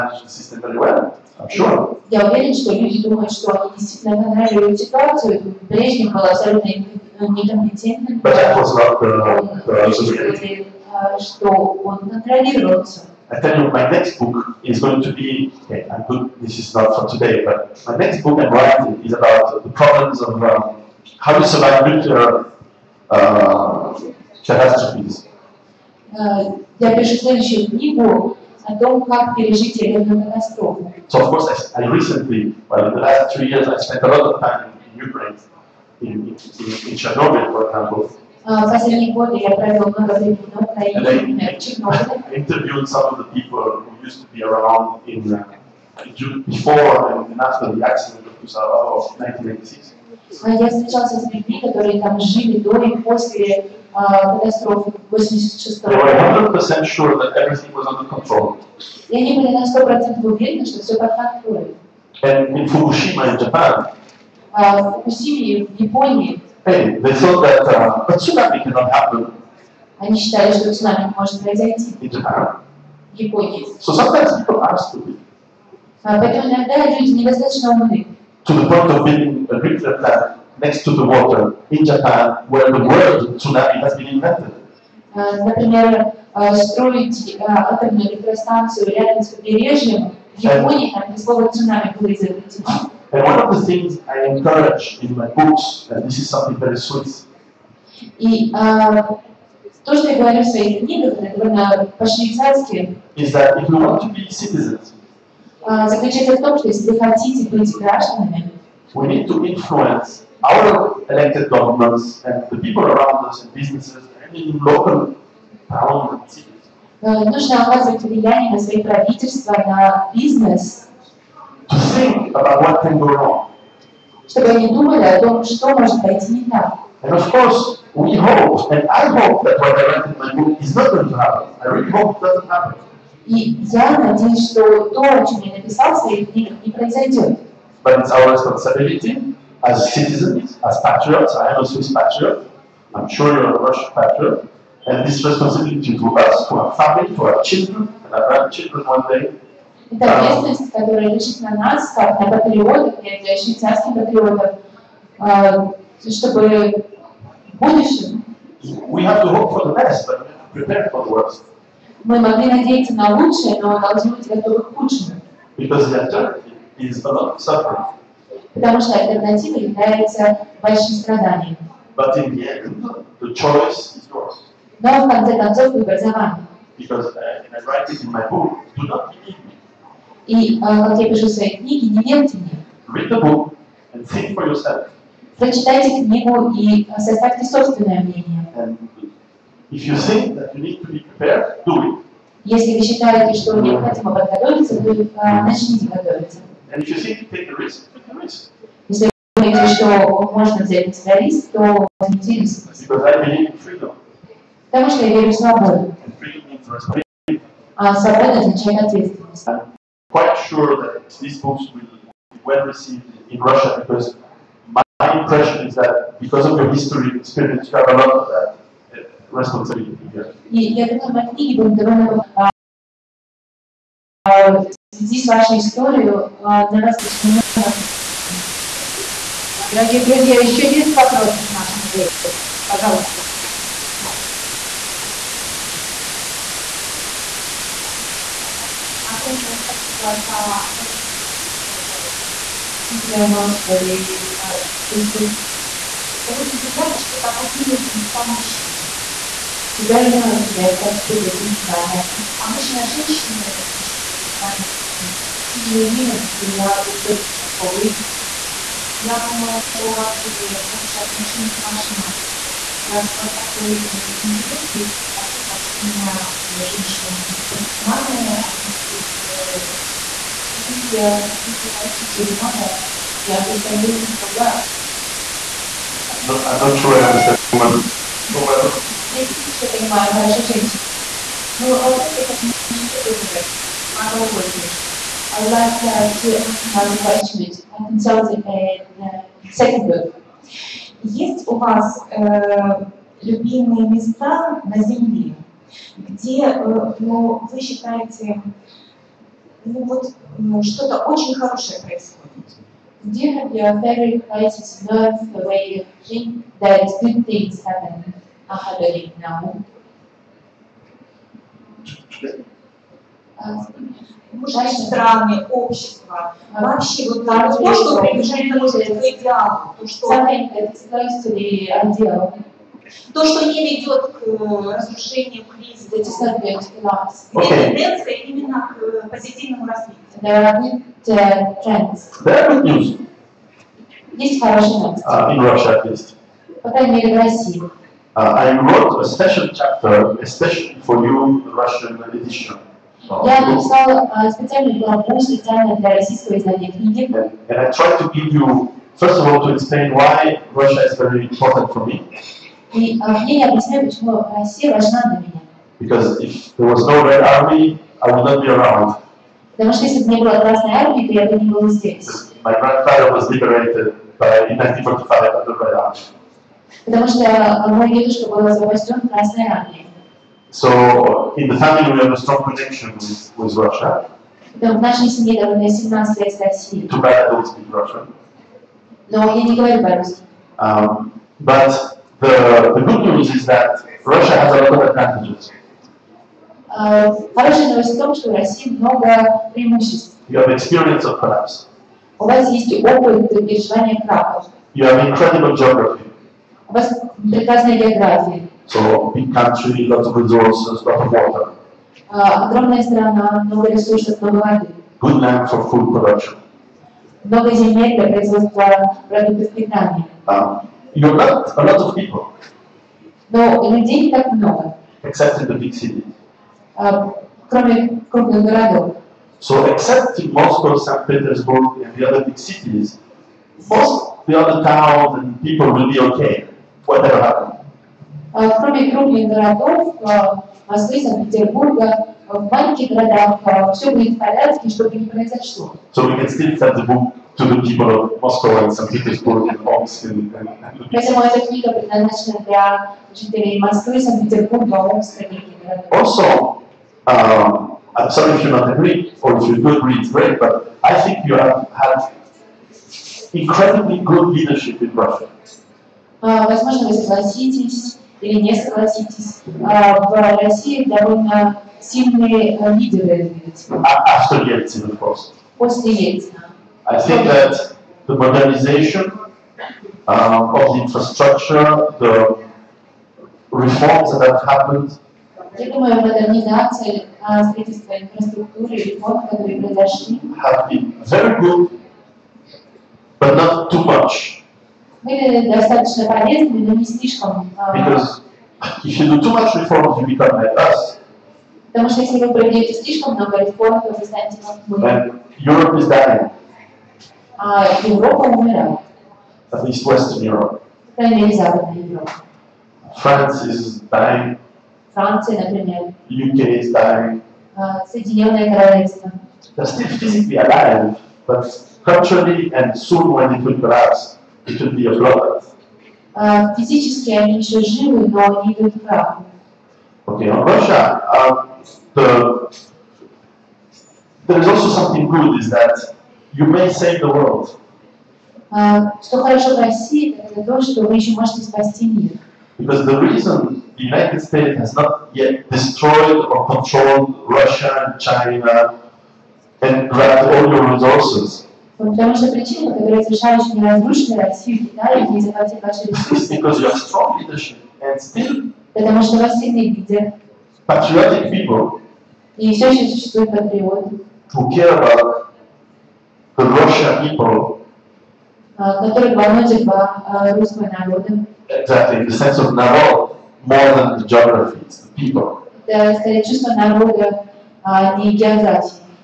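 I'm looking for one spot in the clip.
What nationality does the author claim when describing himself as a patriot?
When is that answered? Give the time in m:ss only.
2:21.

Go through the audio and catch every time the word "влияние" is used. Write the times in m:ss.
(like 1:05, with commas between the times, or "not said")
1:58.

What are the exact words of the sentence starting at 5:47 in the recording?
And I tried to give you, first of all, to explain why Russia is very important for me.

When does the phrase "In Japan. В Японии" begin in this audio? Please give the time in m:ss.
1:12.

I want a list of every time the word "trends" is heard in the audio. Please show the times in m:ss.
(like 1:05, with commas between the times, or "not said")
5:31.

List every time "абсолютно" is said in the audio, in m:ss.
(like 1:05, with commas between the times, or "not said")
0:06.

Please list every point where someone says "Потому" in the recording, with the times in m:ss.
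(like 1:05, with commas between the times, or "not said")
2:48, 3:24, 9:01, 9:08.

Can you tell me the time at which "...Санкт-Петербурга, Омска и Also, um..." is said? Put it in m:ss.
7:24.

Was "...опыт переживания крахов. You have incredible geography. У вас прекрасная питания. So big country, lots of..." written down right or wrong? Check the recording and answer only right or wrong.
wrong.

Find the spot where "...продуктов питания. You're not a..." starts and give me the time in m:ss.
6:49.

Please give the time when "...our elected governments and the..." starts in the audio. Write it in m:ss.
1:50.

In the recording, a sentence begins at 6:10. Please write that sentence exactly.
So, in the family, we have a strong connection with, with Russia.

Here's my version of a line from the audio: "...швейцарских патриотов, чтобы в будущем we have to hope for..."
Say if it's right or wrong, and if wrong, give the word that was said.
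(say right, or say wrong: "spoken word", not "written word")
right.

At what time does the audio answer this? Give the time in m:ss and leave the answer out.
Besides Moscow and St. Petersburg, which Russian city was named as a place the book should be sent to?
7:19.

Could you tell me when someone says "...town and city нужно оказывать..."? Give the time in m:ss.
1:55.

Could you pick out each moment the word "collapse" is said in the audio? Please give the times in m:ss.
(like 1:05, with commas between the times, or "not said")
6:31, 8:33.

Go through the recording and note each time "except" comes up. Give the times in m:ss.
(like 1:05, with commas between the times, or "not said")
6:55, 6:59.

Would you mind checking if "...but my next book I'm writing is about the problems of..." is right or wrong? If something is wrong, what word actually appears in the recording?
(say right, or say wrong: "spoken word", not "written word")
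right.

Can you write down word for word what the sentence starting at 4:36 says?
No, I'm not sure I understand women so well.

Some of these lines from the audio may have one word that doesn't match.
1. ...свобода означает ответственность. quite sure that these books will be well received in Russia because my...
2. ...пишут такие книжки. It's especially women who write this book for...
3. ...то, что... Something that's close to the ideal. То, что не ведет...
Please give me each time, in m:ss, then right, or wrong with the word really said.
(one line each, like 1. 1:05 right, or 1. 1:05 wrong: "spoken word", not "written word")
1. 3:27 right
2. 4:13 wrong: "usually", not "especially"
3. 5:19 right.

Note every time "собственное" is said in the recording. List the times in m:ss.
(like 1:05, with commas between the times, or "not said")
3:07.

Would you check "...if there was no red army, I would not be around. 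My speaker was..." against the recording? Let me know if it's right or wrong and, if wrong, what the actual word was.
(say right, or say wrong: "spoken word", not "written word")
wrong: "grandfather", not "speaker".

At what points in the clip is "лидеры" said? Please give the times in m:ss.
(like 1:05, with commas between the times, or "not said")
7:42, 9:09.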